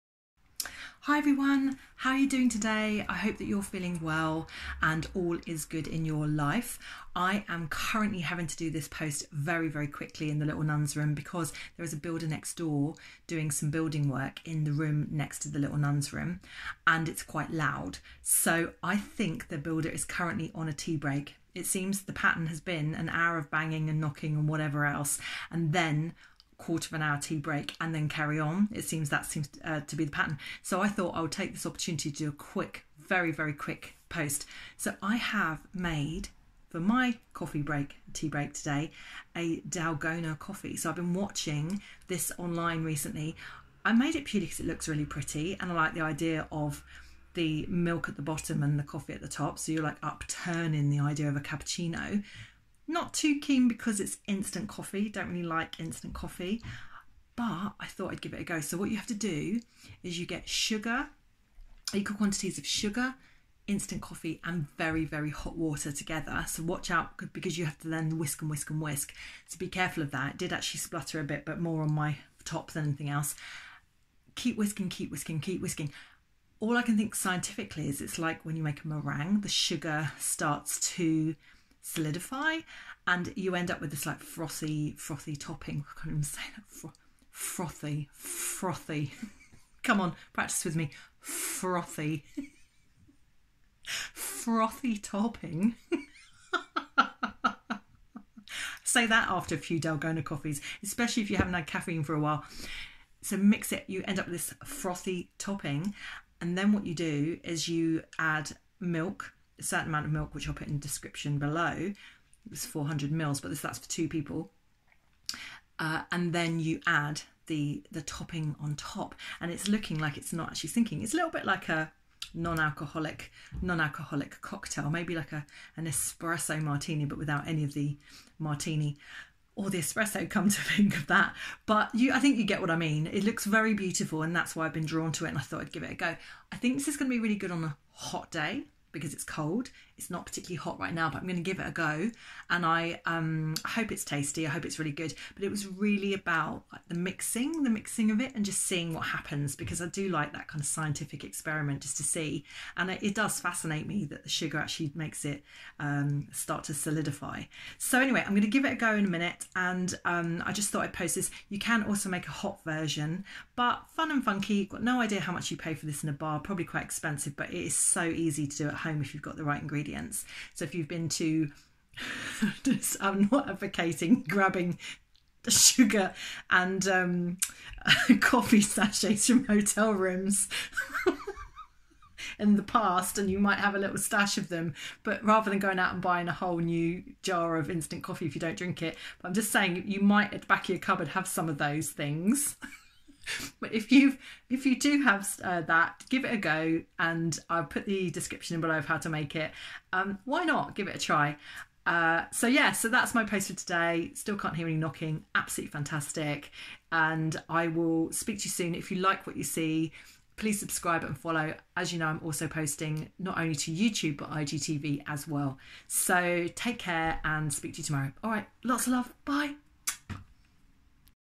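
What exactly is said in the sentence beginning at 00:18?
So I think the builder is currently on a tea break.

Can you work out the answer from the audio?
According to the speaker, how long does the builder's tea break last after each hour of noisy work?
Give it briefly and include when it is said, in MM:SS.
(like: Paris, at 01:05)
quarter of an hour, at 00:26.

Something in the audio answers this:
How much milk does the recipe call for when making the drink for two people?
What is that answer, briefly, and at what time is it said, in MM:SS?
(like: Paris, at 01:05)
400 ml, at 01:52.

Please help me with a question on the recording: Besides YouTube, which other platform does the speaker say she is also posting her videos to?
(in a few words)
IGTV.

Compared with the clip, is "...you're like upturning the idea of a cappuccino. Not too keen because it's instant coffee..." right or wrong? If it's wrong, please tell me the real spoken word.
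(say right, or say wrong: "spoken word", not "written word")
right.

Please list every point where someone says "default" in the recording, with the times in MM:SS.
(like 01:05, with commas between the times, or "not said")
not said.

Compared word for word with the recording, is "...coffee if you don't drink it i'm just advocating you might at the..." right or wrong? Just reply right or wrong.
wrong.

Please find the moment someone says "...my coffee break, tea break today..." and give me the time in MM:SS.
00:36.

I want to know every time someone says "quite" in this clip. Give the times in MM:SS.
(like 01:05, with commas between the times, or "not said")
00:17, 02:46.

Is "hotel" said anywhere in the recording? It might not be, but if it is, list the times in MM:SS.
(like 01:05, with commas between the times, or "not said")
02:59.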